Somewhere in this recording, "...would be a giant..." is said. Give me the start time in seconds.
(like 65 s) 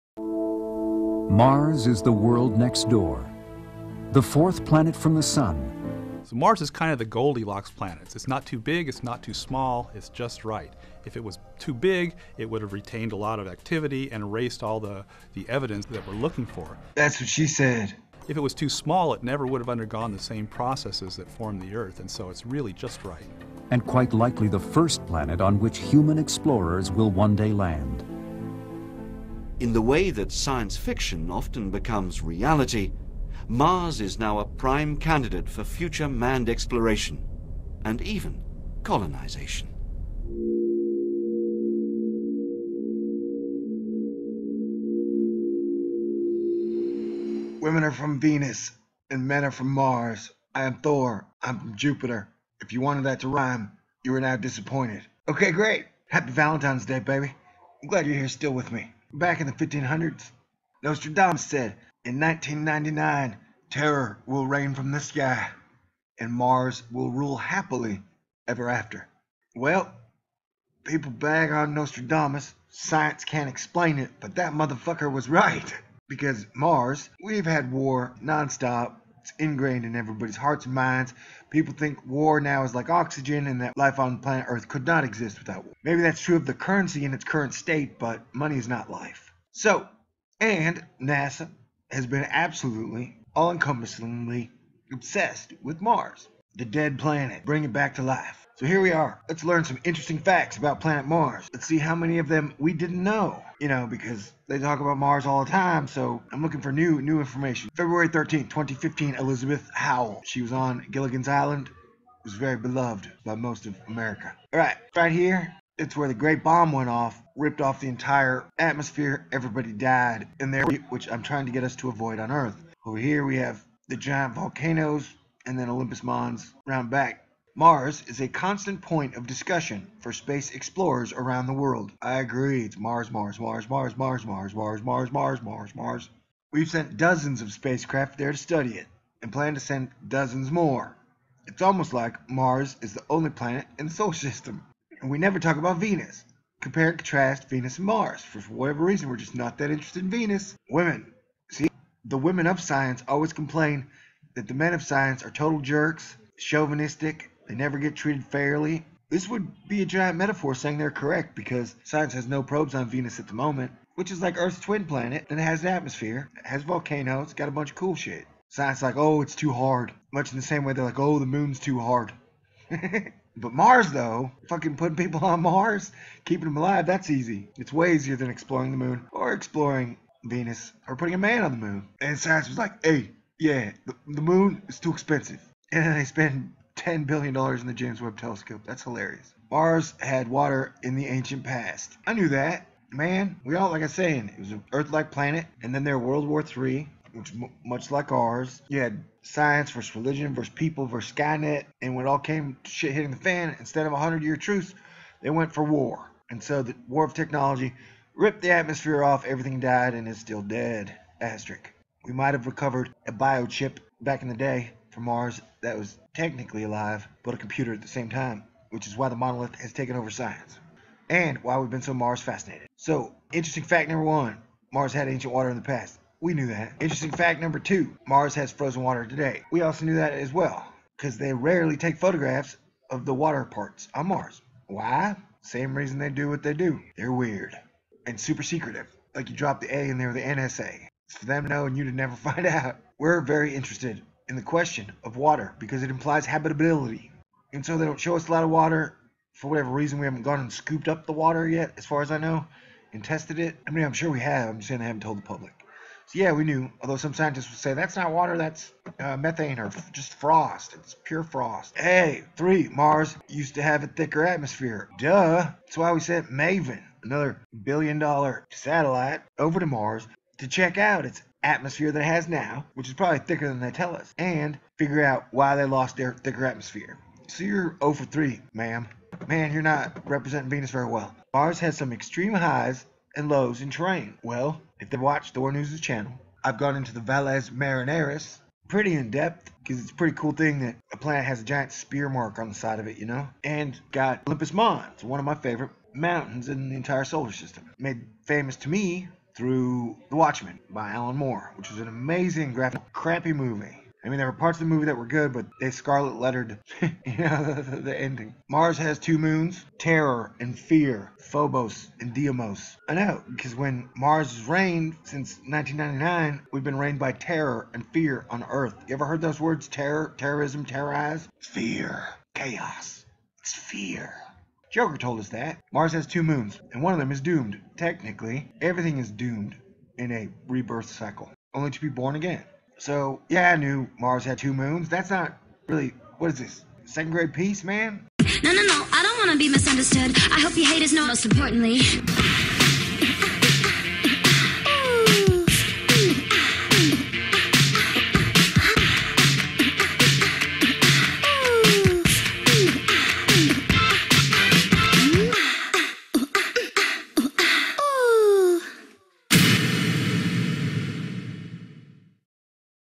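159 s.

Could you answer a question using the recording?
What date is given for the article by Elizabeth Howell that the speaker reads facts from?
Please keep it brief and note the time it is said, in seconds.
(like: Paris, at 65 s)
February 13, 2015, at 107 s.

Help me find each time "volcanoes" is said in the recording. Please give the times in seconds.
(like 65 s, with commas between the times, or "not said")
124 s, 166 s.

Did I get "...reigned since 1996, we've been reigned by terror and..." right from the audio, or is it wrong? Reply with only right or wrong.
wrong.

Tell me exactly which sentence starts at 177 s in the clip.
It's way easier than exploring the moon or exploring Venus or putting a man on the moon.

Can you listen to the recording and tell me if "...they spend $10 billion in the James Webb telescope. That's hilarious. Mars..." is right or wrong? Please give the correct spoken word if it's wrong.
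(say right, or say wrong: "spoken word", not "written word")
right.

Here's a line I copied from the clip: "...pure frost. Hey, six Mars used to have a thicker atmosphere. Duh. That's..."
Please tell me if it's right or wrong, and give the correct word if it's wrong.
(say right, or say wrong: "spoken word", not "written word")
wrong: "three", not "six".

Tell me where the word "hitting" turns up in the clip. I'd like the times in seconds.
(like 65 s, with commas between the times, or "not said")
202 s.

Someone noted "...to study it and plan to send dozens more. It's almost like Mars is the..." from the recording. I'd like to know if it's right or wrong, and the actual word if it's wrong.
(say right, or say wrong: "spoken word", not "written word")
right.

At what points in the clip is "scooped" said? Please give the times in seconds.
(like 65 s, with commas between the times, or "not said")
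250 s.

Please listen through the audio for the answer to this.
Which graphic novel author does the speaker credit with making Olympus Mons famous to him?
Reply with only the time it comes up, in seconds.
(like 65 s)
300 s.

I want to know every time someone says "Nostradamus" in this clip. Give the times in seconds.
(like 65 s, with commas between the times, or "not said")
60 s, 71 s.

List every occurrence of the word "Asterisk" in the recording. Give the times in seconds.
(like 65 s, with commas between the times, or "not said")
211 s.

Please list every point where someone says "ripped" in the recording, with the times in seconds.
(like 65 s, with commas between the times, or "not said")
117 s, 208 s.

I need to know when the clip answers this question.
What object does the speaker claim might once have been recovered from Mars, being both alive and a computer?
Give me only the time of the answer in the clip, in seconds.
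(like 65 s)
213 s.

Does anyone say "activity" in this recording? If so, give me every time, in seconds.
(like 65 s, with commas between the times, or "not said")
13 s.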